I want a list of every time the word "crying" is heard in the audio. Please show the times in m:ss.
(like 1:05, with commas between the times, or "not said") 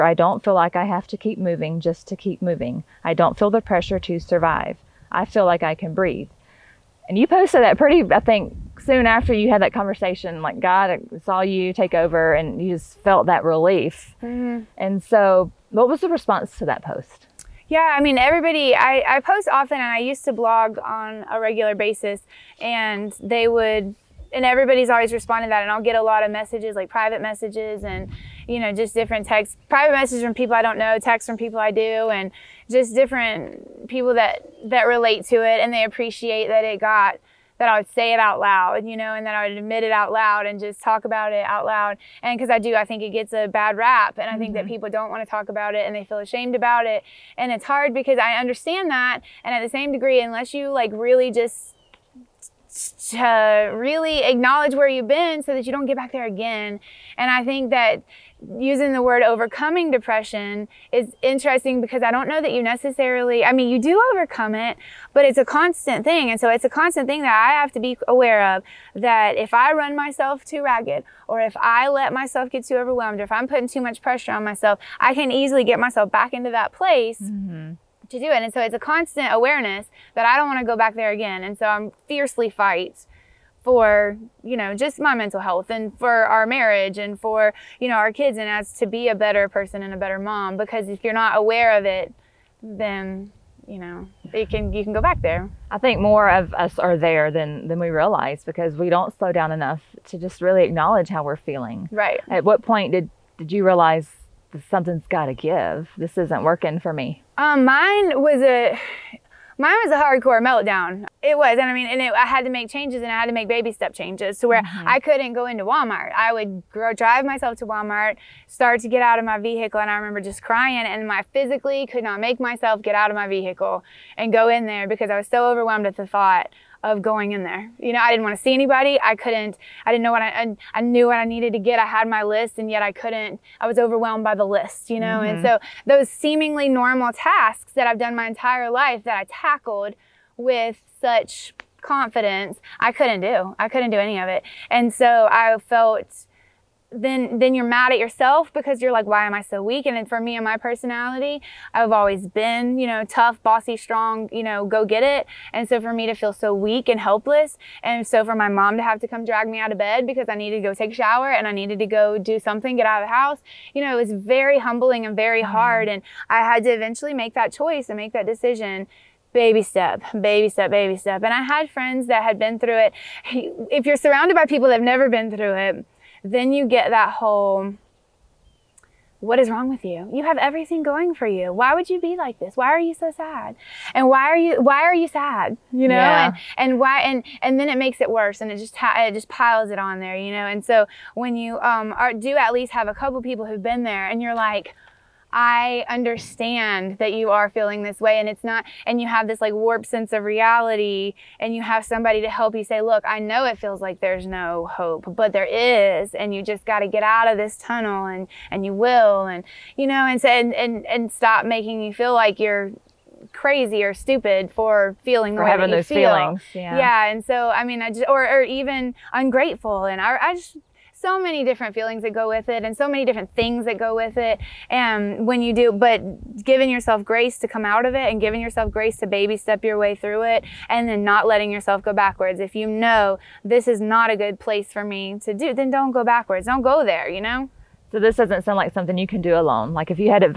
2:00.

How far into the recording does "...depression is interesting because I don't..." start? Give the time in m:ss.
0:59.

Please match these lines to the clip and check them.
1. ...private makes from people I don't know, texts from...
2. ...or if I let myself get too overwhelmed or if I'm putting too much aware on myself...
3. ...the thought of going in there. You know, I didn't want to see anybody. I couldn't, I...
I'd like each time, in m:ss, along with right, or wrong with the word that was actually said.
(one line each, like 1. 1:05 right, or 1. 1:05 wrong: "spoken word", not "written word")
1. 0:29 wrong: "messages", not "makes"
2. 1:11 wrong: "pressure", not "aware"
3. 2:05 right.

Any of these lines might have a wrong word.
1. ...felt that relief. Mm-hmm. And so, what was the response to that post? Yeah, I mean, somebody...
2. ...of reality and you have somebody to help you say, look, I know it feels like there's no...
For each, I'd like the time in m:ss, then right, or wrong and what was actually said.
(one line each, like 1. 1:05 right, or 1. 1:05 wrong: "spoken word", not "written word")
1. 0:12 wrong: "everybody", not "somebody"
2. 3:20 right.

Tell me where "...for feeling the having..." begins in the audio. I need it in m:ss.
3:34.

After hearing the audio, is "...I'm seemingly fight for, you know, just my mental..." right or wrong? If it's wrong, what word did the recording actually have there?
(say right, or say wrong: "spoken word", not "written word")
wrong: "fiercely", not "seemingly".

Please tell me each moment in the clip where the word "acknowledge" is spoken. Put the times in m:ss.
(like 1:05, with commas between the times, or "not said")
0:54, 1:40.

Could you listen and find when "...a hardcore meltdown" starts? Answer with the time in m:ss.
1:49.